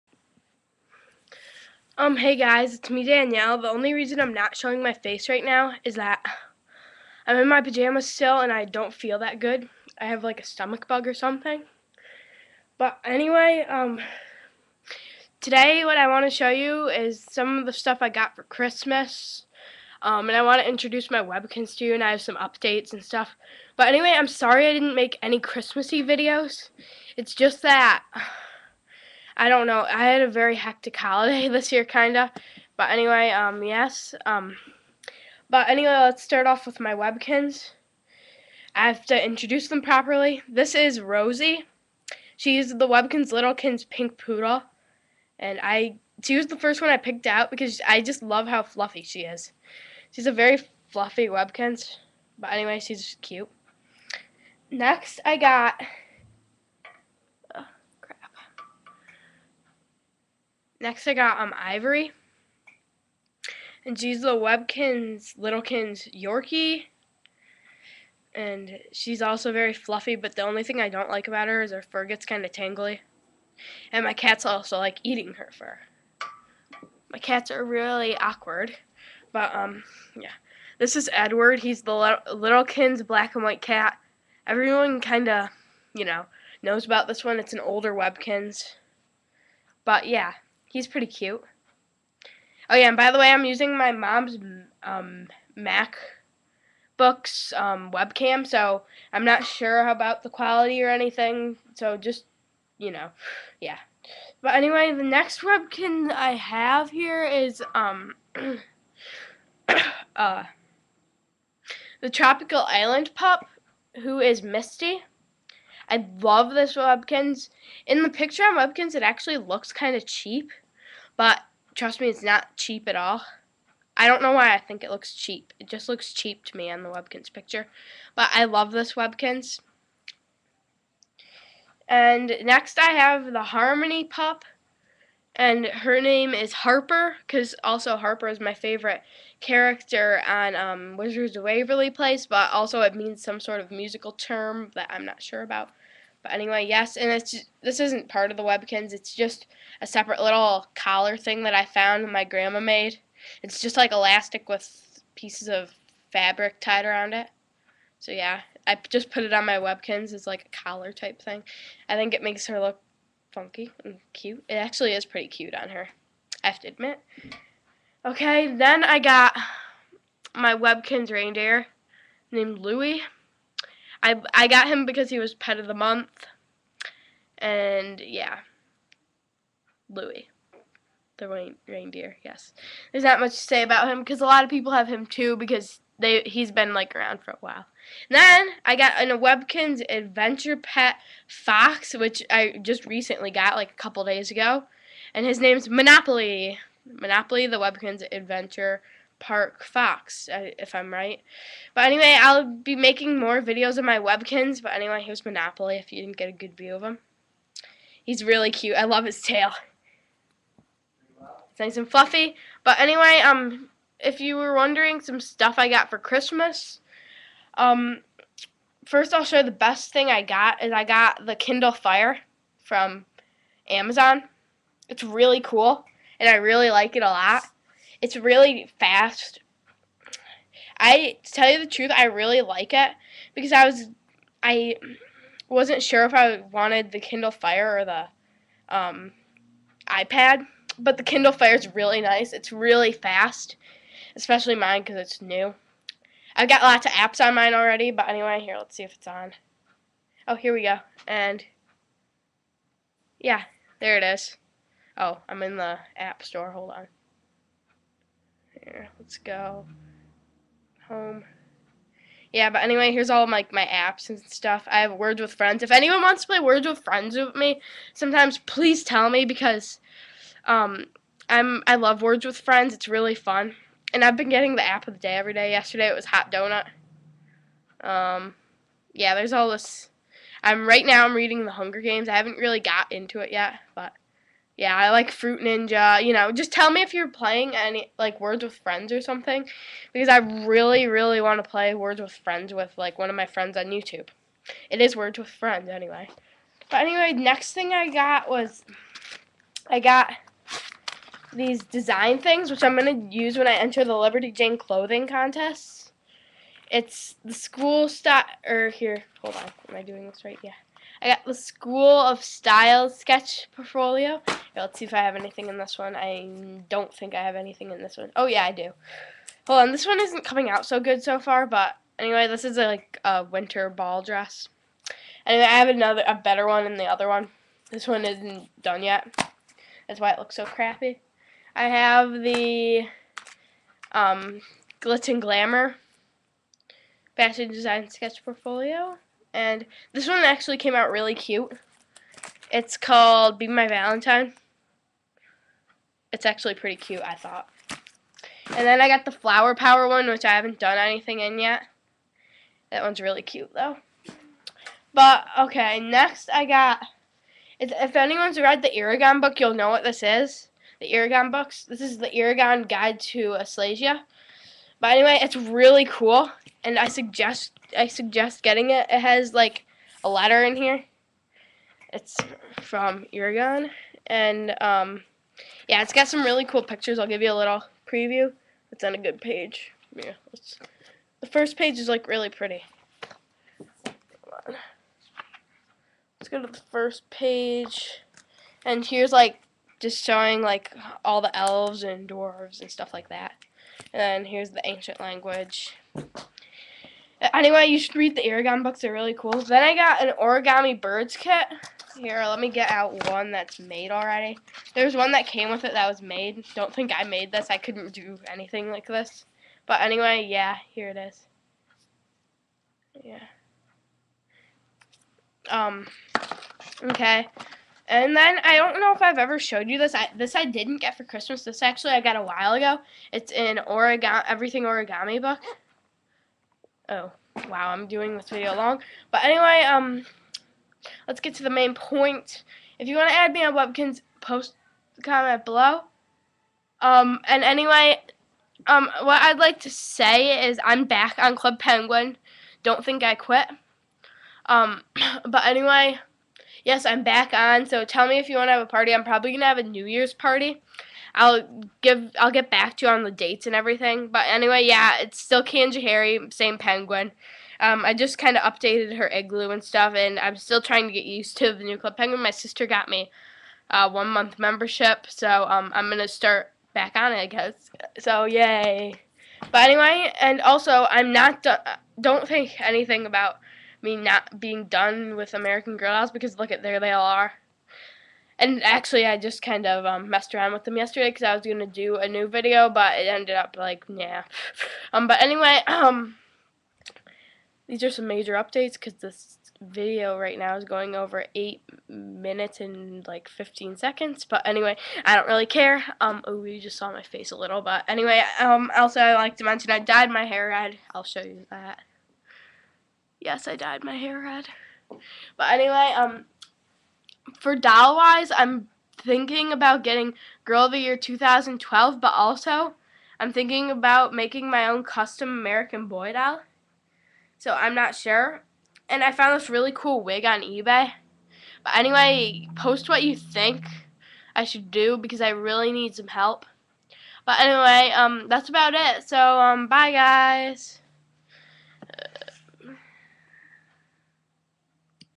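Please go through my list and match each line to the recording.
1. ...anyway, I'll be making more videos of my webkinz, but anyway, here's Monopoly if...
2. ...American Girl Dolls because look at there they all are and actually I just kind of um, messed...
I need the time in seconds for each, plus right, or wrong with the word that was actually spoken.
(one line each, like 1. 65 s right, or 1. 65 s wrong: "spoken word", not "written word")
1. 201 s right
2. 475 s right.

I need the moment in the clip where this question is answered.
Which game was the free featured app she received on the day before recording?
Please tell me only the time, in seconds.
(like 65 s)
276 s.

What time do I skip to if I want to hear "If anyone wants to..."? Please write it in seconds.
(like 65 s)
265 s.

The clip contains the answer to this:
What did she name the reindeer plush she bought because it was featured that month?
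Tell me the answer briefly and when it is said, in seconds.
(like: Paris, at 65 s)
Louie, at 172 s.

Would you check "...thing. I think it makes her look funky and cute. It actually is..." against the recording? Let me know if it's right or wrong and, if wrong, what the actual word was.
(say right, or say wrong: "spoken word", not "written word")
right.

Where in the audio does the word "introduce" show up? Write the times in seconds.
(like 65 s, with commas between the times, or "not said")
20 s, 39 s.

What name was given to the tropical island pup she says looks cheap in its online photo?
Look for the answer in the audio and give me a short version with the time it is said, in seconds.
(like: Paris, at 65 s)
Misty, at 114 s.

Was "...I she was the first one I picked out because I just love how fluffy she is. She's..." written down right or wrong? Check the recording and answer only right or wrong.
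right.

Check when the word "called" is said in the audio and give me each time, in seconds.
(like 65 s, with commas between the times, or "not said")
342 s.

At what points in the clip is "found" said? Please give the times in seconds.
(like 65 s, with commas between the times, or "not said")
151 s, 519 s.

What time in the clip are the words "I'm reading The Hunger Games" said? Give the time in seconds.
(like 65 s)
281 s.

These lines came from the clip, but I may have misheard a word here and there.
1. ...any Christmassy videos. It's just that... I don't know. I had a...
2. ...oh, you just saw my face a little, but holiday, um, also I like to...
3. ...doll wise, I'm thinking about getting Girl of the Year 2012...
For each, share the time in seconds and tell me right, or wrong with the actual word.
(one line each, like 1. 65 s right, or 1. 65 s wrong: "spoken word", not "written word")
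1. 25 s right
2. 496 s wrong: "anyway", not "holiday"
3. 507 s right.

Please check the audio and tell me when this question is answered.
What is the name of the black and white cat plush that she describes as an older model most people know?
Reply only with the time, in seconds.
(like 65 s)
81 s.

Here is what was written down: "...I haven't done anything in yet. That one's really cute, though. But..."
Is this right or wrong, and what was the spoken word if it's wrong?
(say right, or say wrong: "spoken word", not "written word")
right.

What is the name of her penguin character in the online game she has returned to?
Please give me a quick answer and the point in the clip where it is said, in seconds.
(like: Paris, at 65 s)
Harry, at 455 s.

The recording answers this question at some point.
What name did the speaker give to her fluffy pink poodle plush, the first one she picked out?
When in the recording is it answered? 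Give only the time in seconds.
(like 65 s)
41 s.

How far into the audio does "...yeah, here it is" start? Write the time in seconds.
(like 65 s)
410 s.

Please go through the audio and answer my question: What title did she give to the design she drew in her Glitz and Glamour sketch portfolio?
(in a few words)
Be My Valentine.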